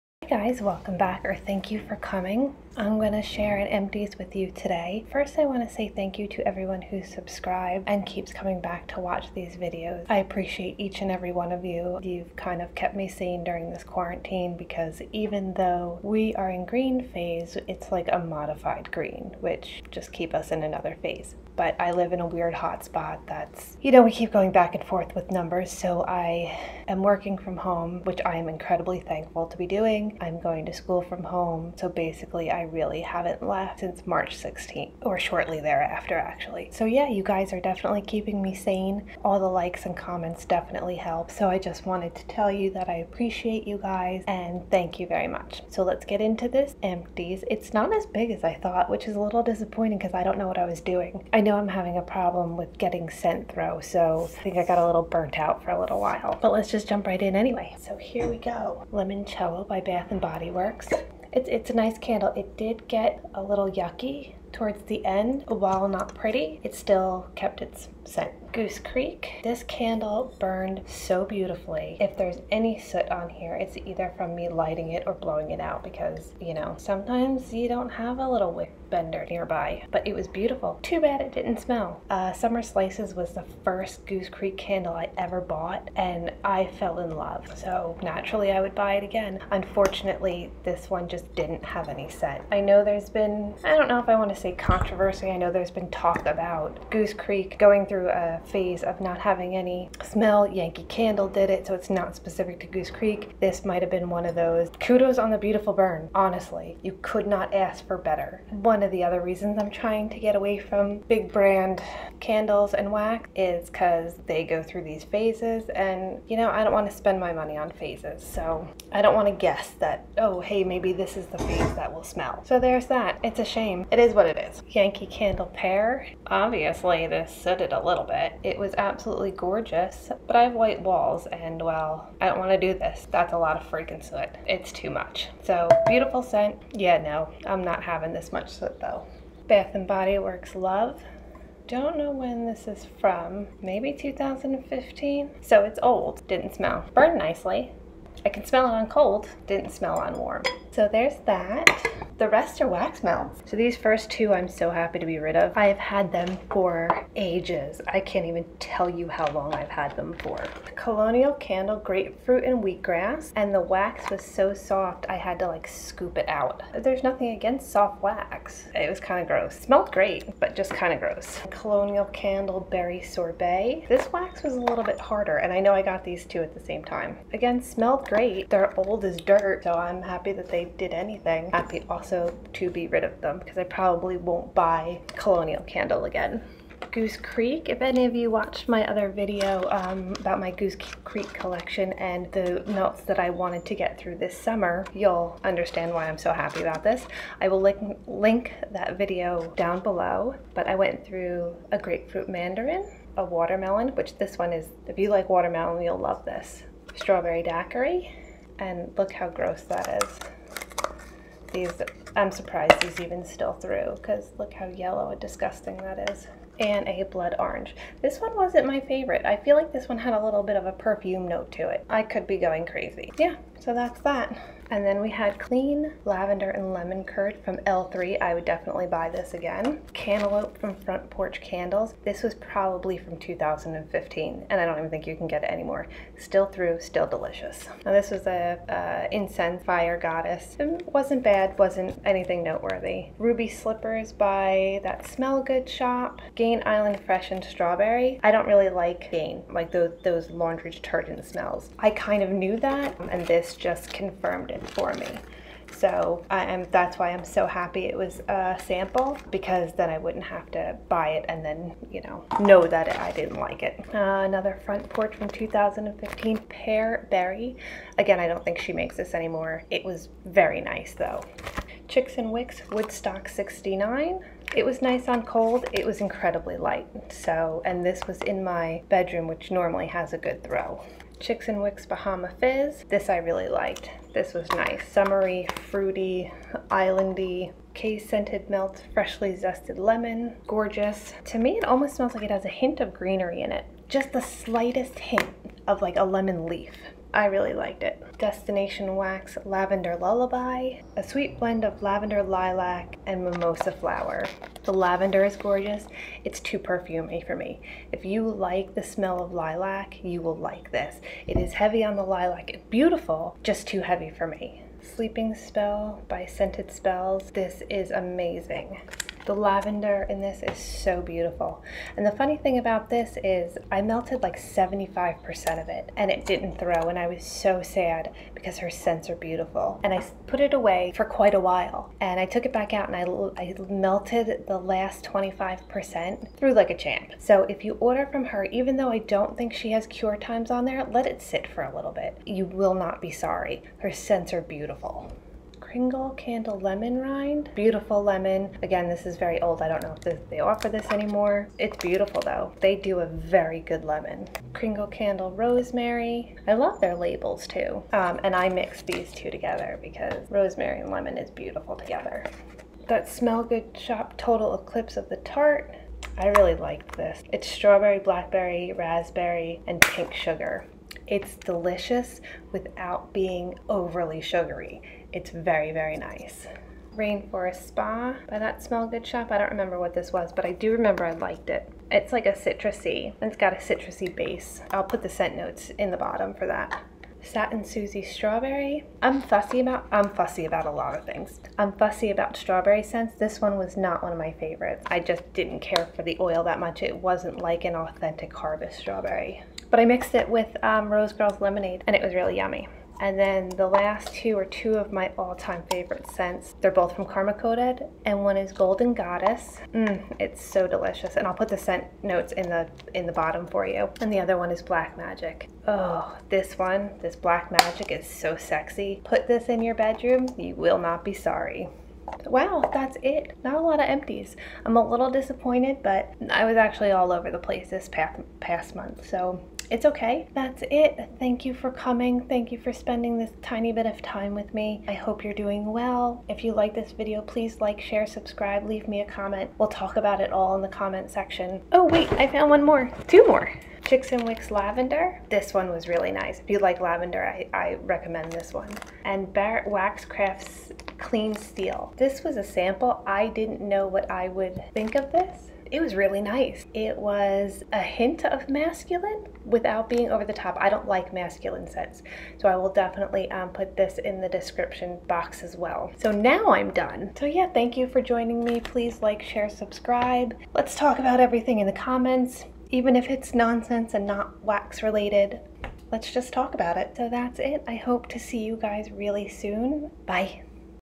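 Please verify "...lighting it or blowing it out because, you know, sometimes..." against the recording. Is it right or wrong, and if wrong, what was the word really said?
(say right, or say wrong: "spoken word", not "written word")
right.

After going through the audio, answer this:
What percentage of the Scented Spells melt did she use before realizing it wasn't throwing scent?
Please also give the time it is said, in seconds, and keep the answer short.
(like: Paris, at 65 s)
75%, at 324 s.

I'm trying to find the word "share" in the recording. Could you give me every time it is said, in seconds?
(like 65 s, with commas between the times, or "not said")
3 s, 437 s, 469 s.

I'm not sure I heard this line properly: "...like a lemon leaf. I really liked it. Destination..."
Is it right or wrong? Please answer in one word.
right.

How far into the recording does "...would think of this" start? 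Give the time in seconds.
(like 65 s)
454 s.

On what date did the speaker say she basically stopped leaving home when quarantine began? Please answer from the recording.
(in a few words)
March 16th.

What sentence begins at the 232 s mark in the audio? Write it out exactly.
This was probably from 2015, and I don't even think you can get it anymore.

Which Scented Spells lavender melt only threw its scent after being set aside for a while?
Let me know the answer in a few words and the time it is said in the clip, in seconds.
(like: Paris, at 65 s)
Sleeping Spell, at 314 s.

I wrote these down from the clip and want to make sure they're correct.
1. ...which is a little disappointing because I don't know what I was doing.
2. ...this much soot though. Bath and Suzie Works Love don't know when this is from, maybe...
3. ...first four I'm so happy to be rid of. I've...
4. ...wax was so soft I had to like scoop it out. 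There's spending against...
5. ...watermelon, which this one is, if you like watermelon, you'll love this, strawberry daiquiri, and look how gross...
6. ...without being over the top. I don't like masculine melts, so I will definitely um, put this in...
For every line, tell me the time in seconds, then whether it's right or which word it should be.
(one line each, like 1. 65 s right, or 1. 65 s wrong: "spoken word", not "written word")
1. 48 s right
2. 138 s wrong: "Body", not "Suzie"
3. 153 s wrong: "two", not "four"
4. 163 s wrong: "nothing", not "spending"
5. 203 s right
6. 459 s wrong: "scents", not "melts".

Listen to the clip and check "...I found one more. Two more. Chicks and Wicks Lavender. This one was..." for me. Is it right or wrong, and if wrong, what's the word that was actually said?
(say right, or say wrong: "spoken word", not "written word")
right.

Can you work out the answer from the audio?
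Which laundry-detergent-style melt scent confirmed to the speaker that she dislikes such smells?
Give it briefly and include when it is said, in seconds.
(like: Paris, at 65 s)
Gain Island Fresh, at 246 s.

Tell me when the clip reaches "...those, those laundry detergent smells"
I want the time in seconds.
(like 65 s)
249 s.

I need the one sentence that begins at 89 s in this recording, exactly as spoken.
Unfortunately, this one just didn't have any scent.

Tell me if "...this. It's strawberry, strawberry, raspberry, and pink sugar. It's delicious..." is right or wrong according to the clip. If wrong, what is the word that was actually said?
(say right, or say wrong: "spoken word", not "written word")
wrong: "blackberry", not "strawberry".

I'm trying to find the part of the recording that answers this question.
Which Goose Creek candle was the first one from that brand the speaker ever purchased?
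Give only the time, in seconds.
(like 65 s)
82 s.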